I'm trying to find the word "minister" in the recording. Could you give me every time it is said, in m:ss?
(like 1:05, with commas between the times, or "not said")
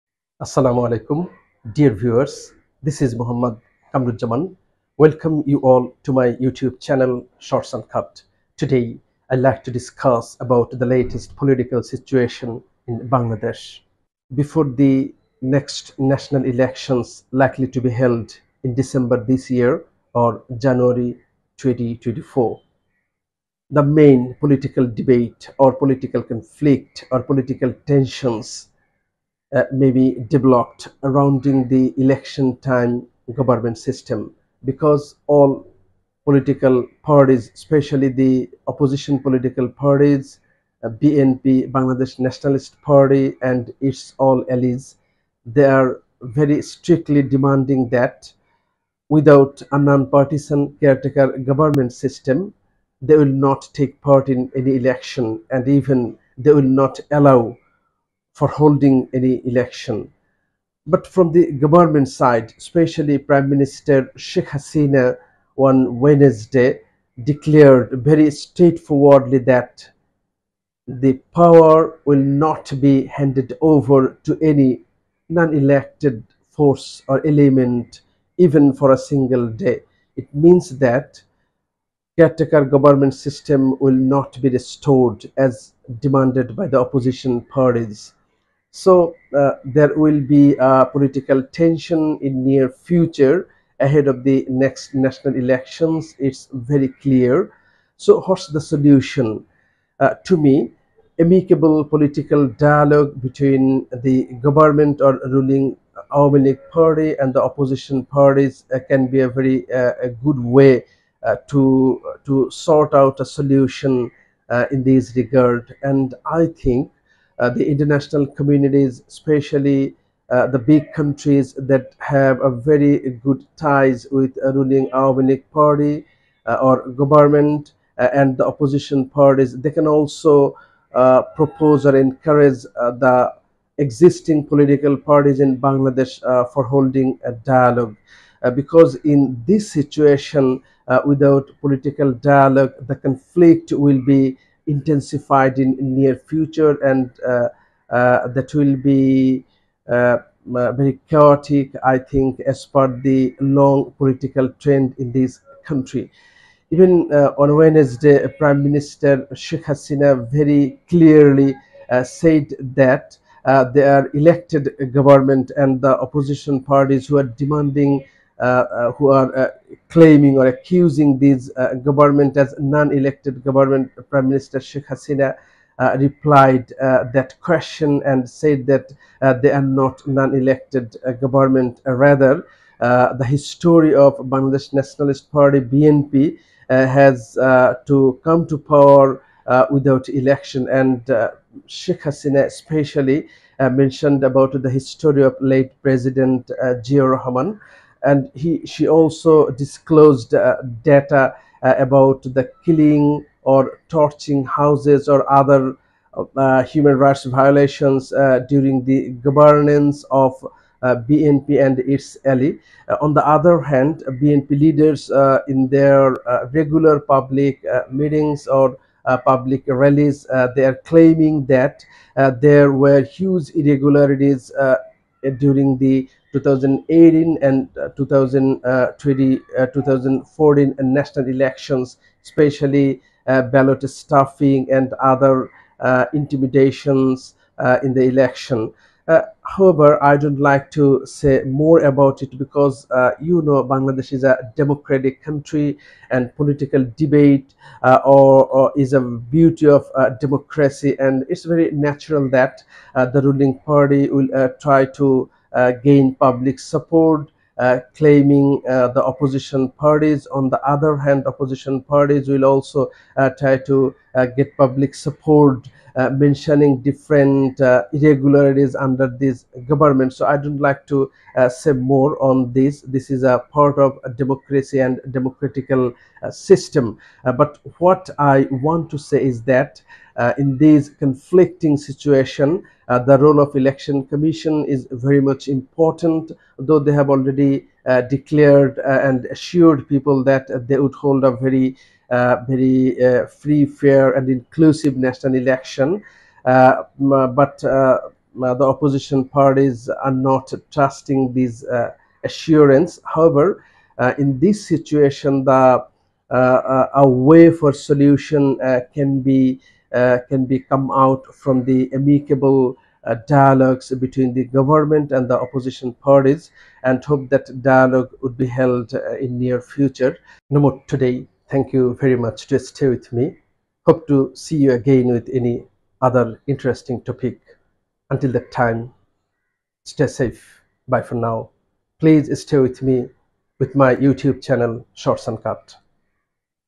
1:03, 2:38, 2:54.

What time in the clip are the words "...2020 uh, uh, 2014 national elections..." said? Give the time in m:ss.
3:47.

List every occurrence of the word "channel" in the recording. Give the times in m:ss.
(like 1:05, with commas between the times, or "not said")
0:06, 5:34.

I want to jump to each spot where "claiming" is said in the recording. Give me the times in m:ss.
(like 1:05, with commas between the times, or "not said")
2:49, 3:40, 4:17.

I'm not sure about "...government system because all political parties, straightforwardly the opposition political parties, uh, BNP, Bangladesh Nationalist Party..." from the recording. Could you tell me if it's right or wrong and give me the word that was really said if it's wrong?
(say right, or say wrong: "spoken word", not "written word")
wrong: "especially", not "straightforwardly".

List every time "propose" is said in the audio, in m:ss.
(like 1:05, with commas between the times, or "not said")
2:11.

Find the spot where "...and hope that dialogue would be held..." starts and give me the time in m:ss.
5:16.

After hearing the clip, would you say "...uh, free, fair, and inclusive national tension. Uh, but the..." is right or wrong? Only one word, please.
wrong.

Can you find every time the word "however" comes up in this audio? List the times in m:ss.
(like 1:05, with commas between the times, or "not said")
3:59, 5:03.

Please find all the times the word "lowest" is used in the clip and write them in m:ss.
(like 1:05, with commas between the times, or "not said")
not said.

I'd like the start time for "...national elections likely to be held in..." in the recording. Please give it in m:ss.
0:15.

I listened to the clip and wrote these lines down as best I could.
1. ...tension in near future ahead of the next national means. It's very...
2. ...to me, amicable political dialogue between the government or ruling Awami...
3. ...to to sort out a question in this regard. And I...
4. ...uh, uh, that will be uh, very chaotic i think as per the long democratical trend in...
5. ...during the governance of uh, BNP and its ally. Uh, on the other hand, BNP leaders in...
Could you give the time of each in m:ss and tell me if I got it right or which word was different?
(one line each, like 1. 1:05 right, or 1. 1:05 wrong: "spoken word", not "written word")
1. 1:31 wrong: "elections", not "means"
2. 1:40 right
3. 1:51 wrong: "solution", not "question"
4. 2:27 wrong: "political", not "democratical"
5. 3:28 right.